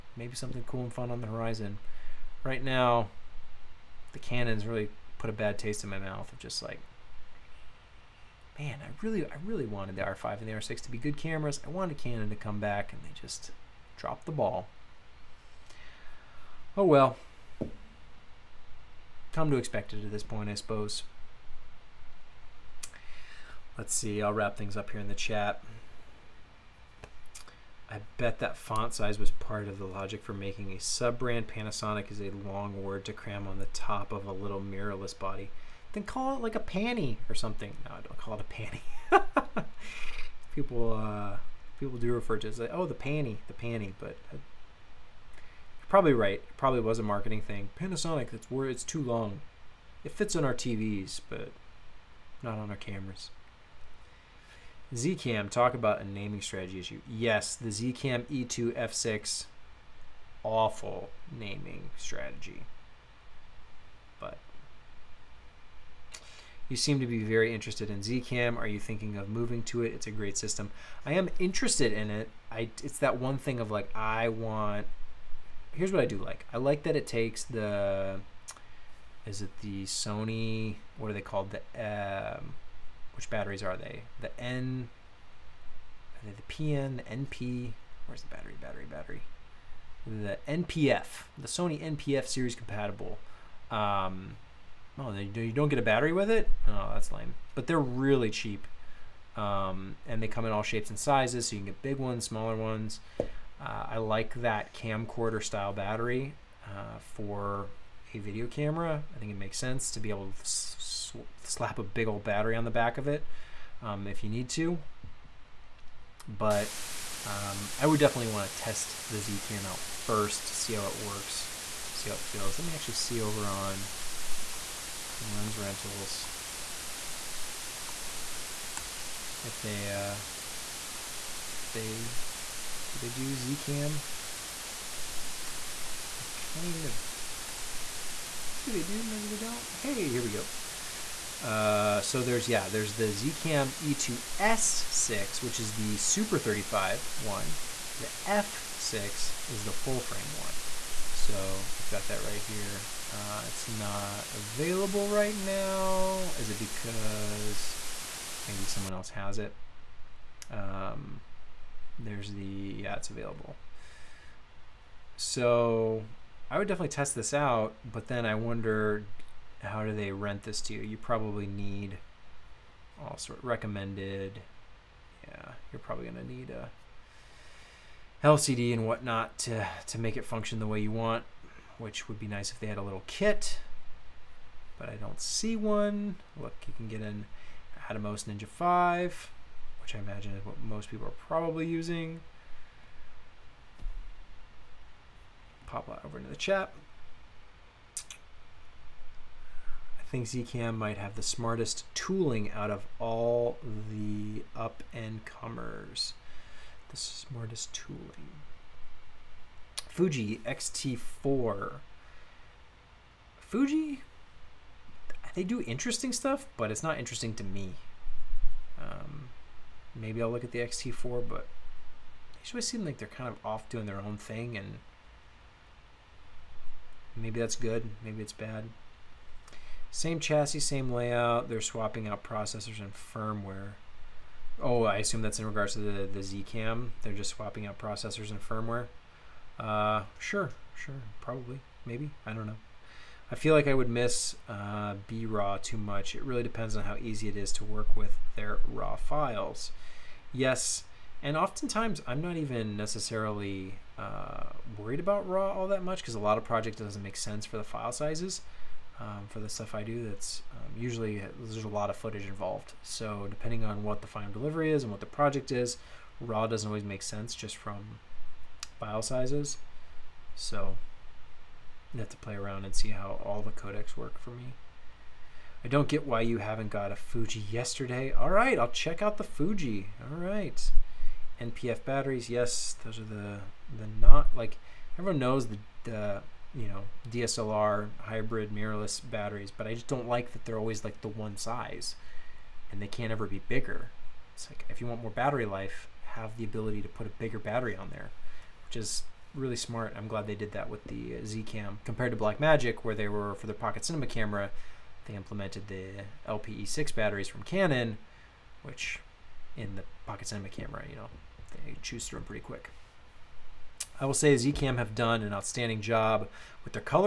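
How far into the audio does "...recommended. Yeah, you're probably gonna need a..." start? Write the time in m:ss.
2:53.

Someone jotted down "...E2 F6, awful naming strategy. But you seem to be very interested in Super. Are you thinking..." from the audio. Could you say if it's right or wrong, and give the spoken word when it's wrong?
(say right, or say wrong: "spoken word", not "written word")
wrong: "Zcam", not "Super".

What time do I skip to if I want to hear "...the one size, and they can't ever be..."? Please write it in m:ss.
4:51.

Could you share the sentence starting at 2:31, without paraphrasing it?
So we've got that right here.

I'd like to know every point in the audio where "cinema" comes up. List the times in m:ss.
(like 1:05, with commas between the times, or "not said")
5:03, 5:10.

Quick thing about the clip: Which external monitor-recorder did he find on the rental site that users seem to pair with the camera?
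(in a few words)
Atomos Ninja 5.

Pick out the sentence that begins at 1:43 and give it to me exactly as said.
Uh, I like that camcorder style battery uh, for a video camera.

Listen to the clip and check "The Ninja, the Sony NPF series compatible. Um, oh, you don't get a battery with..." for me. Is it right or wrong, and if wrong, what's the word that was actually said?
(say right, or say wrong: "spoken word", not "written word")
wrong: "NPF", not "Ninja".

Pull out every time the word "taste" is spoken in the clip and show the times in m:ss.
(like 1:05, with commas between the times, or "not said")
0:05.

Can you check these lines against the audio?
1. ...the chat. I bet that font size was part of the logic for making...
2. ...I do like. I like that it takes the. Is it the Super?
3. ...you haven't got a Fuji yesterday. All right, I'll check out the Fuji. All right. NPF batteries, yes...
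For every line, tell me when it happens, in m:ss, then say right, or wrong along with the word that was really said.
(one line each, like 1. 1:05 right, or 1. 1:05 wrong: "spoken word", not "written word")
1. 0:25 right
2. 1:16 wrong: "Sony", not "Super"
3. 4:36 right.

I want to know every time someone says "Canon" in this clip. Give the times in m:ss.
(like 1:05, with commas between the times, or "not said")
0:04, 0:11, 5:07.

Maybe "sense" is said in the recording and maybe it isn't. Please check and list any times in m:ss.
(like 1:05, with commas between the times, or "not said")
1:49, 4:17, 4:27.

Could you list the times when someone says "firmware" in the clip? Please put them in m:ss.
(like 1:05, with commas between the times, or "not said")
3:52, 3:58.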